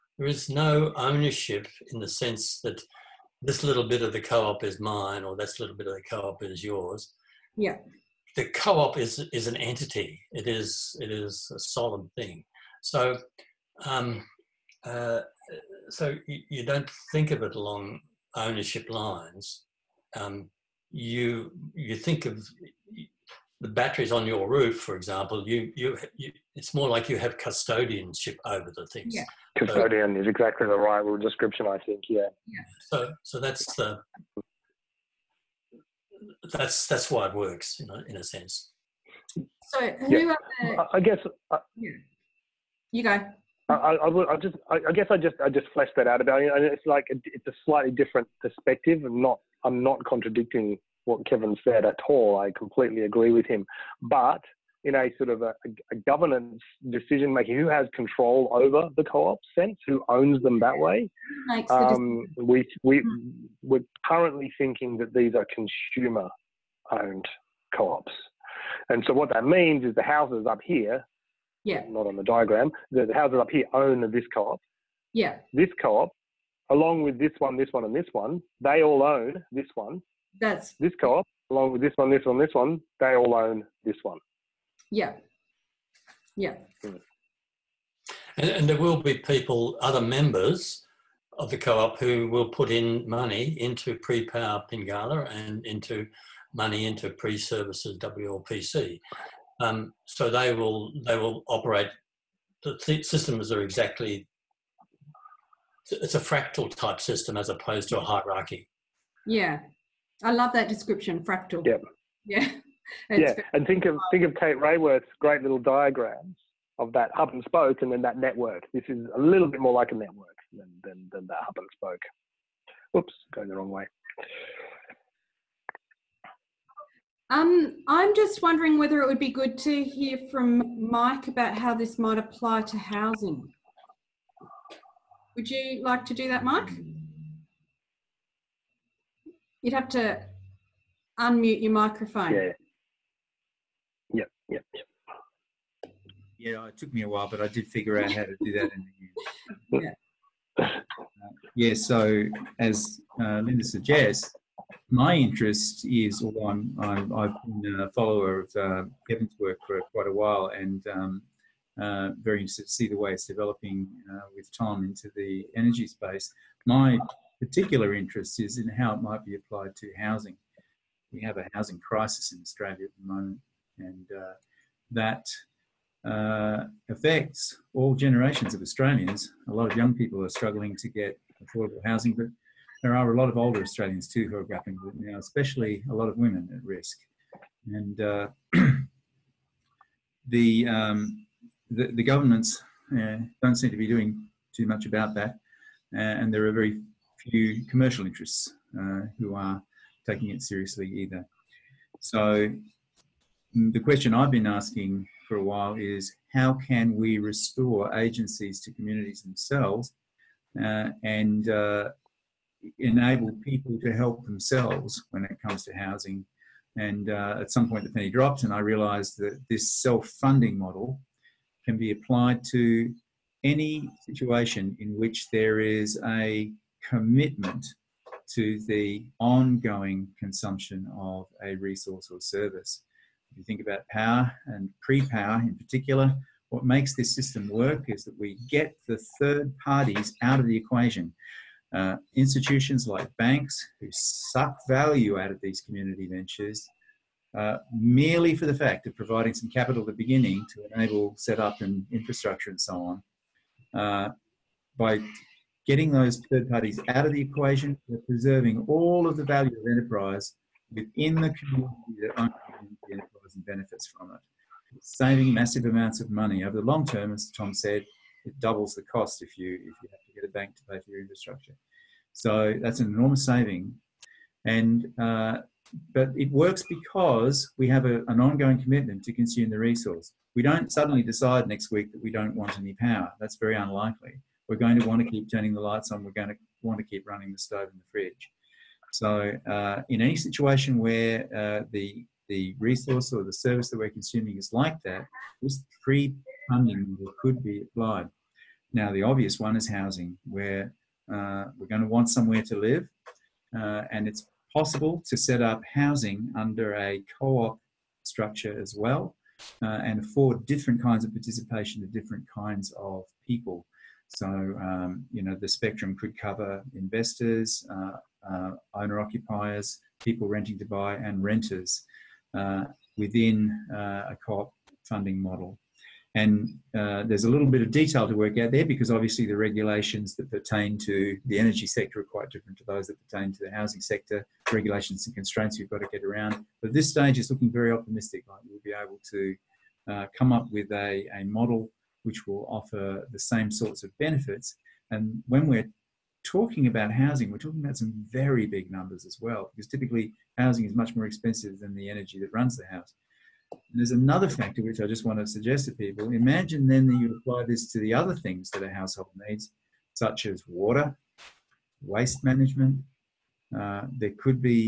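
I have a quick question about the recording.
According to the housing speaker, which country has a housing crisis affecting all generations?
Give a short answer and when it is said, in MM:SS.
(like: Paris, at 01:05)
Australia, at 02:52.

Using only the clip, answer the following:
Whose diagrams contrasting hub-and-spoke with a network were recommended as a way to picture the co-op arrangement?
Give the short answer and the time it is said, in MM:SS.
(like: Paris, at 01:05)
Kate Raworth, at 01:54.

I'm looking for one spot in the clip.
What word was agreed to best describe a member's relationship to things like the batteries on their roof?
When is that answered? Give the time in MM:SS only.
00:27.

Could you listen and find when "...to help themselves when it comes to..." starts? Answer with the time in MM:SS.
03:33.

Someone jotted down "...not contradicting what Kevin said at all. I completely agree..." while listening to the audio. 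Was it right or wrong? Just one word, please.
right.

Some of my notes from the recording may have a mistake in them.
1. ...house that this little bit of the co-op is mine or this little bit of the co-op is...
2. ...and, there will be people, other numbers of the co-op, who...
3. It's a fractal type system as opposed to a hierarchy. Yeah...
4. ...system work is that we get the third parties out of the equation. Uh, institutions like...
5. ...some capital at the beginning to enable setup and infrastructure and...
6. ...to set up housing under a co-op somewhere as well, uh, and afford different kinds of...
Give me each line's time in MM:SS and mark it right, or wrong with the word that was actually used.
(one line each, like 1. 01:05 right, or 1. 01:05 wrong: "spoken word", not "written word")
1. 00:02 wrong: "sense", not "house"
2. 01:28 wrong: "members", not "numbers"
3. 01:45 right
4. 03:57 right
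5. 04:09 right
6. 05:05 wrong: "structure", not "somewhere".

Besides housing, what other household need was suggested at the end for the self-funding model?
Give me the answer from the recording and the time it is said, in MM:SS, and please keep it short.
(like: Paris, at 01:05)
Water, at 06:00.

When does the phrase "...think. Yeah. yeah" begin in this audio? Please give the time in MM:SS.
00:31.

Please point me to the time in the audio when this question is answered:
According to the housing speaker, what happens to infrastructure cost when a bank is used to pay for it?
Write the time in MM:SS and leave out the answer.
04:28.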